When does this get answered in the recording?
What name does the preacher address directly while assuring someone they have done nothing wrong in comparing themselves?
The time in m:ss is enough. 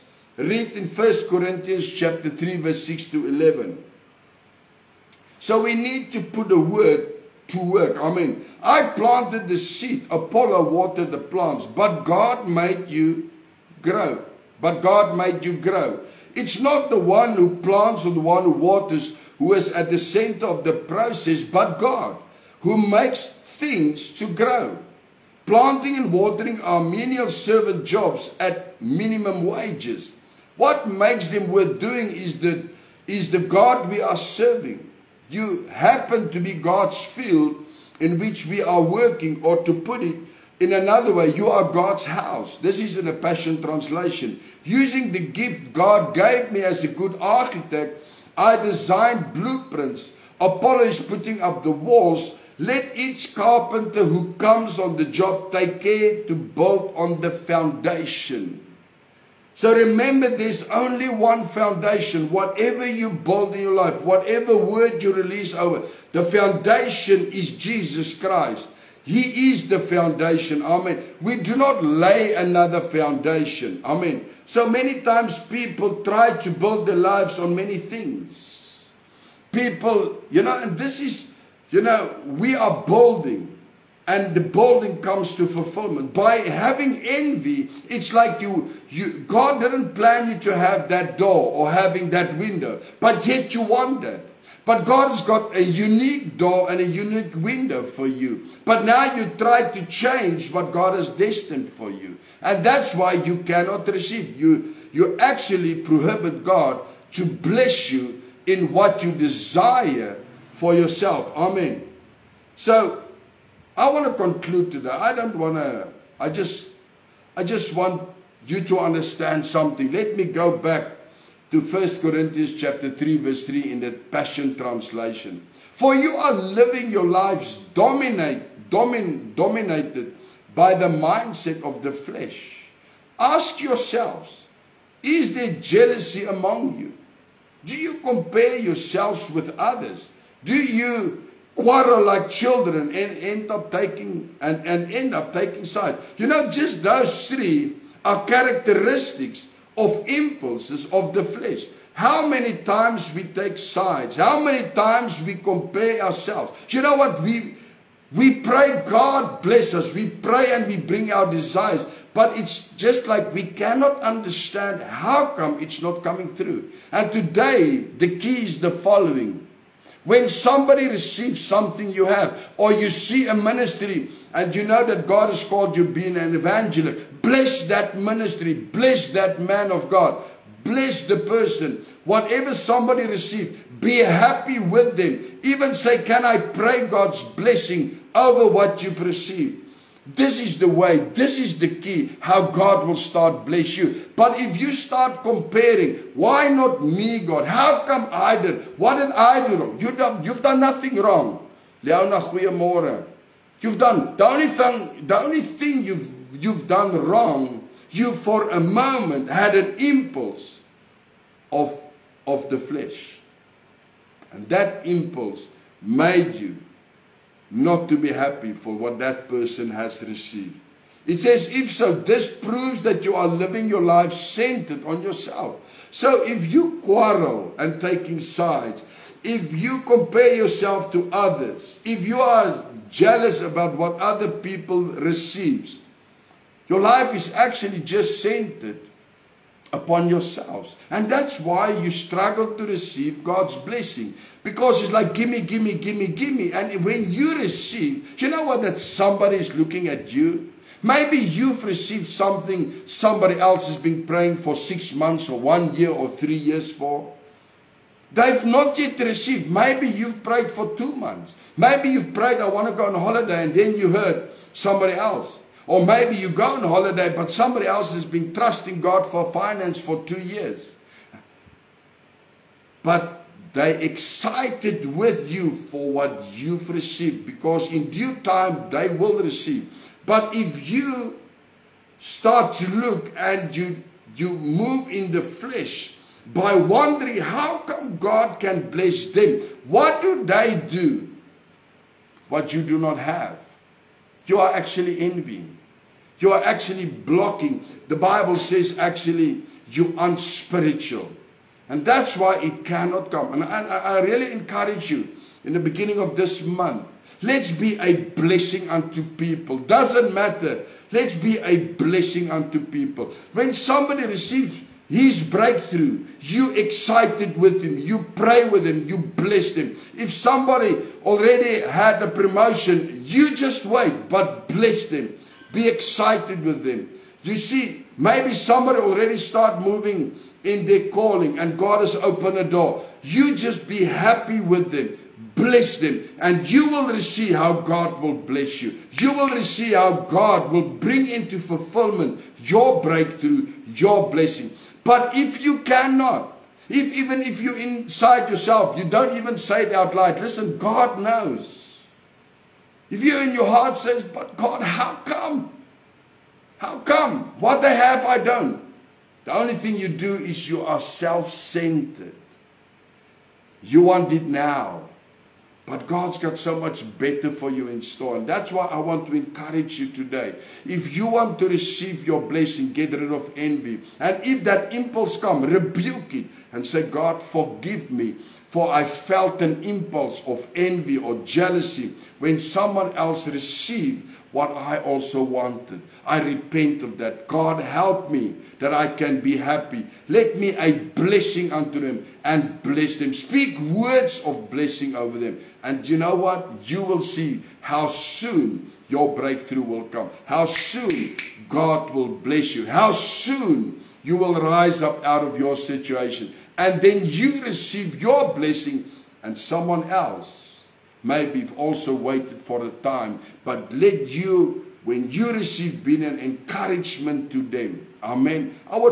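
3:21.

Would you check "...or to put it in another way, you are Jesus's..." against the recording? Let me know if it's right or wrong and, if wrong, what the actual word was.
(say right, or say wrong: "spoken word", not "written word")
wrong: "God", not "Jesus".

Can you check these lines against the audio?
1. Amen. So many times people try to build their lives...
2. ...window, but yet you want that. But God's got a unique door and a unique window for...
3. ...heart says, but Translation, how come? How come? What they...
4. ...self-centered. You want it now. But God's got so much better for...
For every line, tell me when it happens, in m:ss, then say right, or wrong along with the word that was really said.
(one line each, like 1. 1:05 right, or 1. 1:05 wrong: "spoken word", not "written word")
1. 1:13 right
2. 1:32 right
3. 5:53 wrong: "God", not "Translation"
4. 6:00 right.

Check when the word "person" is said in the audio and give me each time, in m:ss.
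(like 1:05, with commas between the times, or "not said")
3:01, 3:39.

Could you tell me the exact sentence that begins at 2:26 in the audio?
You know, just those three are characteristics of impulses of the flesh.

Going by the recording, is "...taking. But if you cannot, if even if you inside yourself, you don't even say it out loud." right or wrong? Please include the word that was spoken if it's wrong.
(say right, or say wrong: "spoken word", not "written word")
wrong: "blessing", not "taking".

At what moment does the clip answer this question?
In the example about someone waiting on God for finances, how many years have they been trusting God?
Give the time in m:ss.
4:30.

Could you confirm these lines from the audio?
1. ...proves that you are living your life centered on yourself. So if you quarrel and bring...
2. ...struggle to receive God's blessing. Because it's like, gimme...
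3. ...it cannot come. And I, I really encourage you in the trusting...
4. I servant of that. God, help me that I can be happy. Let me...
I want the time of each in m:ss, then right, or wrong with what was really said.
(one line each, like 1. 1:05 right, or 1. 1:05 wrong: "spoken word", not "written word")
1. 3:42 wrong: "taking", not "bring"
2. 4:01 right
3. 5:02 wrong: "beginning", not "trusting"
4. 6:26 wrong: "repent", not "servant".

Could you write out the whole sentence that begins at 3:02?
Whatever somebody received, be happy with them.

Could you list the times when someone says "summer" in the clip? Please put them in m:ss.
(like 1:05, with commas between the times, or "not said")
not said.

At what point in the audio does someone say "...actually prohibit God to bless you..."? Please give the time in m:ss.
1:45.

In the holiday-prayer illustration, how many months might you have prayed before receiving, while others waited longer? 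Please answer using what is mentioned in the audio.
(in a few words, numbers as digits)
2 months.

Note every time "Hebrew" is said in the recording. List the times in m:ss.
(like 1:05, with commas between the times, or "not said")
not said.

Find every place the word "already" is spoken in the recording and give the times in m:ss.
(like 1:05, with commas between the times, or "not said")
5:21, 5:28.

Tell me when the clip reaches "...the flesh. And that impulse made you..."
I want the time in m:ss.
3:32.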